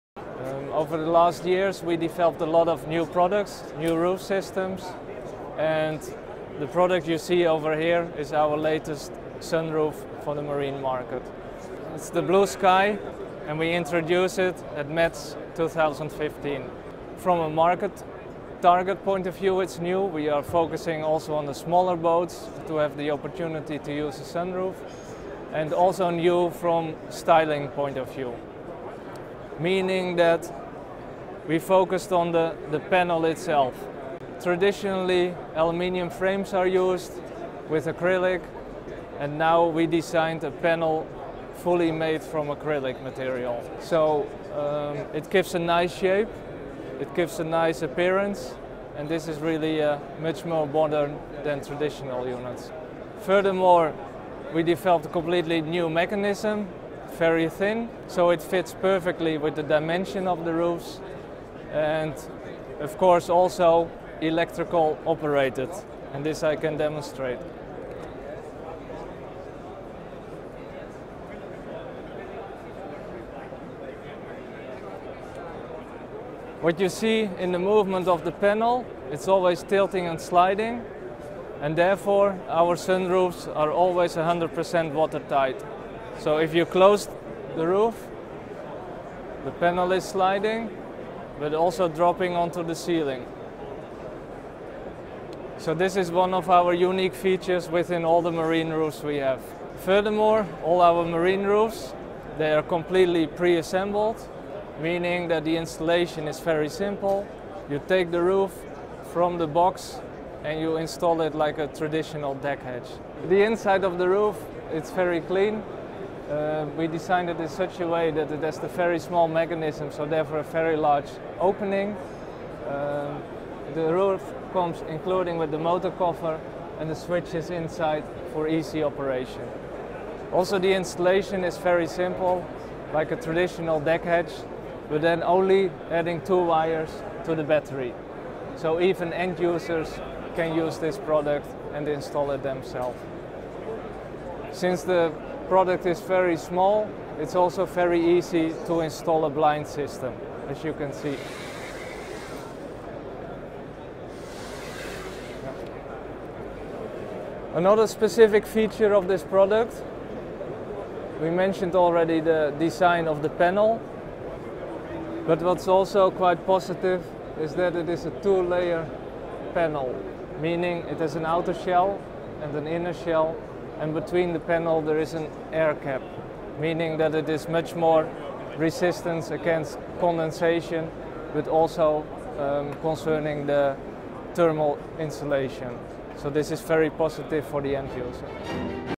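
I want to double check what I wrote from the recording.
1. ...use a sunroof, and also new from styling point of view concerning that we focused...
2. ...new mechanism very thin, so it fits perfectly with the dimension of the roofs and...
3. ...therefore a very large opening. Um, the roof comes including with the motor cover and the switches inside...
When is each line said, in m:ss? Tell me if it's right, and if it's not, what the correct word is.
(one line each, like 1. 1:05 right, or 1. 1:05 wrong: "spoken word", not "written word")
1. 0:23 wrong: "meaning", not "concerning"
2. 0:55 right
3. 2:00 right.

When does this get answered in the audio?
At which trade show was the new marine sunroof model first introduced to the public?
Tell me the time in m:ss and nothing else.
0:14.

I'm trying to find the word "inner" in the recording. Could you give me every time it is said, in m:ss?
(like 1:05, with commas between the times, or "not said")
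2:52.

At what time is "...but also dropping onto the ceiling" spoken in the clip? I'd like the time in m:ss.
1:31.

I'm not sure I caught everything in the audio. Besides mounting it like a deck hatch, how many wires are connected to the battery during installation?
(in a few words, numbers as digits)
2.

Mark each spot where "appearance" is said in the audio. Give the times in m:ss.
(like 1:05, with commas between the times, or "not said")
0:47.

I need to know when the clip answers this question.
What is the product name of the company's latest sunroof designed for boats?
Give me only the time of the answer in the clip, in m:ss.
0:12.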